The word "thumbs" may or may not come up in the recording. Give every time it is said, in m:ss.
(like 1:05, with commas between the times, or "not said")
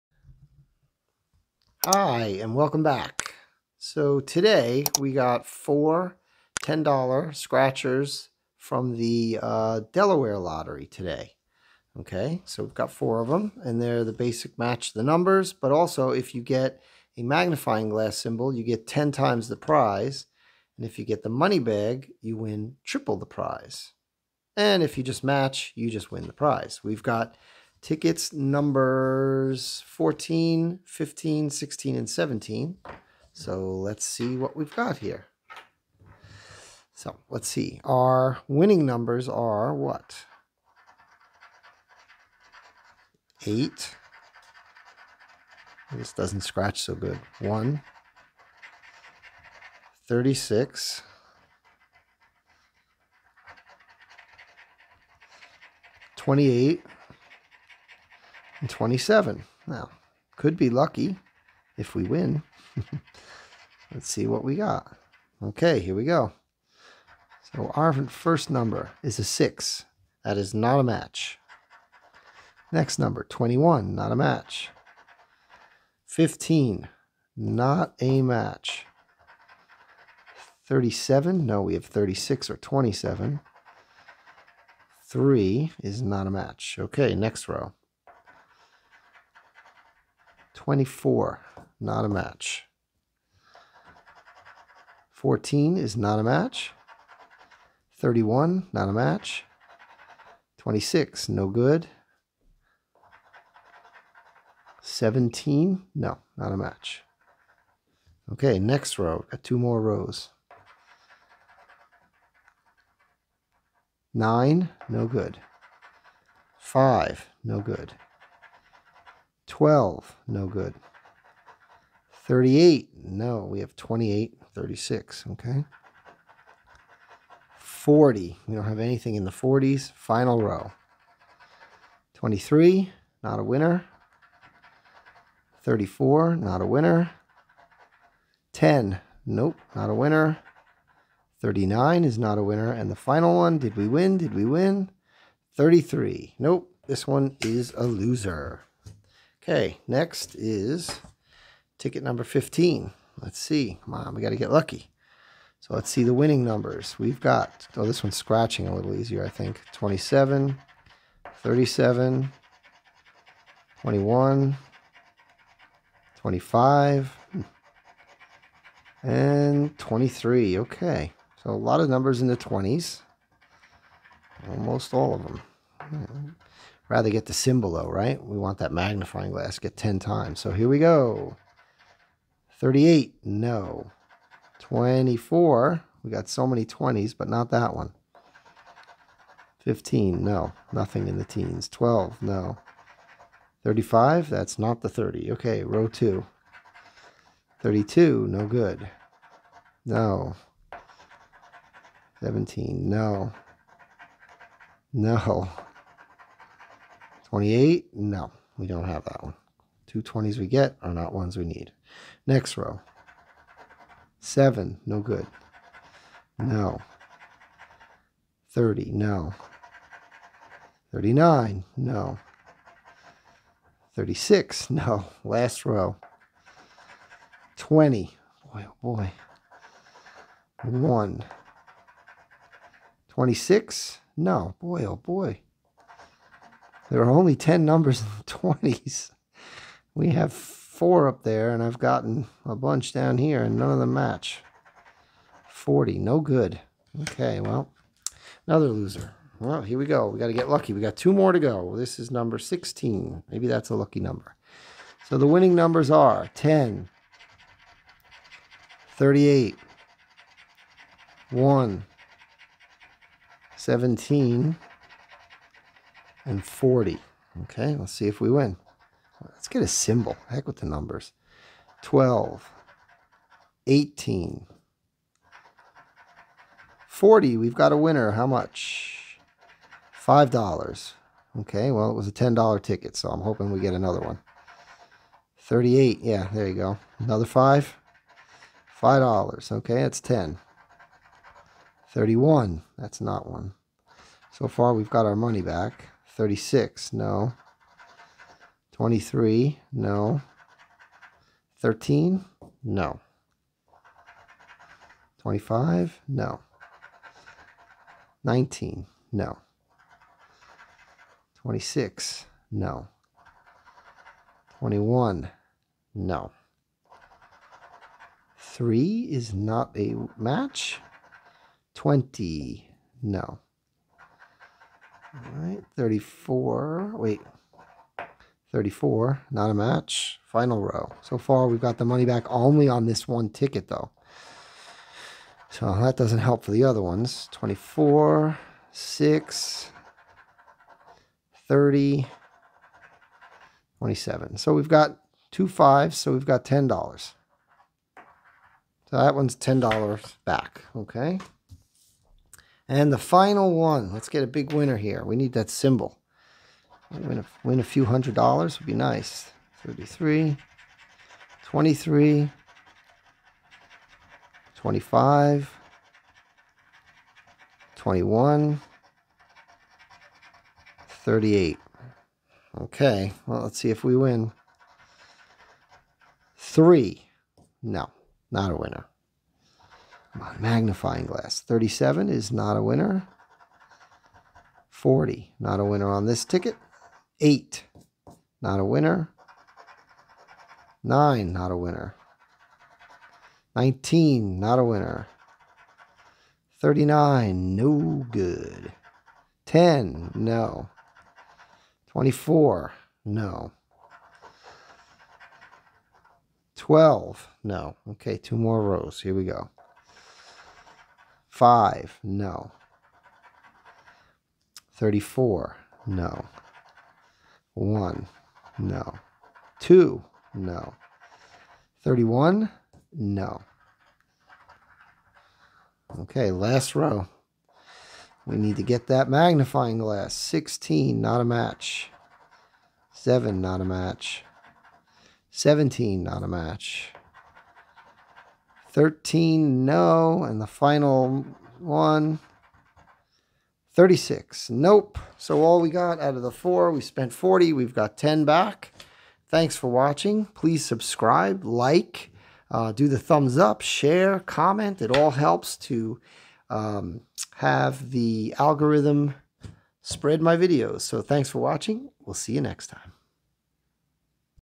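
7:32.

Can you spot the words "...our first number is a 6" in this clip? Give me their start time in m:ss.
1:07.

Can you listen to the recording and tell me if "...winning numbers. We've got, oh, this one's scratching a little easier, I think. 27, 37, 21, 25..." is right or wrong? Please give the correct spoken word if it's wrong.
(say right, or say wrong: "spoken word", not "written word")
right.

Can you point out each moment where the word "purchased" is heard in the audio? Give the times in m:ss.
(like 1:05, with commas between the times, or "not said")
not said.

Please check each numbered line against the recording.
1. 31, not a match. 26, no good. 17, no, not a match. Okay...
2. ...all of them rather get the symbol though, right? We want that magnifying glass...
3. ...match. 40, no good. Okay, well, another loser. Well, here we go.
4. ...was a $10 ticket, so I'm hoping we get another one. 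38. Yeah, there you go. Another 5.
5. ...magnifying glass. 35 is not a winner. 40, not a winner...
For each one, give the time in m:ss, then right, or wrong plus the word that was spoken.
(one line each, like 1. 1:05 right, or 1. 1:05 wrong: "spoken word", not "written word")
1. 1:37 right
2. 2:54 right
3. 4:03 right
4. 4:41 right
5. 6:20 wrong: "37", not "35".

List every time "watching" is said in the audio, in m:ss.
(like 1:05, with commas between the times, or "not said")
7:29, 7:41.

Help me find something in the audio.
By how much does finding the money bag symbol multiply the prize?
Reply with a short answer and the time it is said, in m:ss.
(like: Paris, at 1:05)
triple, at 0:22.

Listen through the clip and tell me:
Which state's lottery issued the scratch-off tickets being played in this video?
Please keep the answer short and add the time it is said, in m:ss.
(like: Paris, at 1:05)
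Delaware, at 0:09.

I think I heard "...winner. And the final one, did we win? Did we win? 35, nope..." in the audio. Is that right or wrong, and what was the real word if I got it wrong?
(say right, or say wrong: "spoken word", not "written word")
wrong: "33", not "35".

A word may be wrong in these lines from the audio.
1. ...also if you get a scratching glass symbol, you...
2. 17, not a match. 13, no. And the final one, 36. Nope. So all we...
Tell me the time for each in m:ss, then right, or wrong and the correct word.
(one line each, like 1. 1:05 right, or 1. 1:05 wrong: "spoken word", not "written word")
1. 0:15 wrong: "magnifying", not "scratching"
2. 7:15 right.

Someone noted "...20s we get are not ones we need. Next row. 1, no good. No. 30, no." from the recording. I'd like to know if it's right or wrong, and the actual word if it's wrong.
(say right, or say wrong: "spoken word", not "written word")
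wrong: "7", not "1".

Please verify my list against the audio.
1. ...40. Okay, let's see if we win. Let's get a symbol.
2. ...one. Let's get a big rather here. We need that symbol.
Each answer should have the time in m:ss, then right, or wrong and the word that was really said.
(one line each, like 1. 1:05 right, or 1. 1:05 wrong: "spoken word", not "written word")
1. 4:26 right
2. 5:53 wrong: "winner", not "rather".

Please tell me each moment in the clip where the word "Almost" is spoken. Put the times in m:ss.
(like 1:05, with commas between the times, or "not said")
2:54.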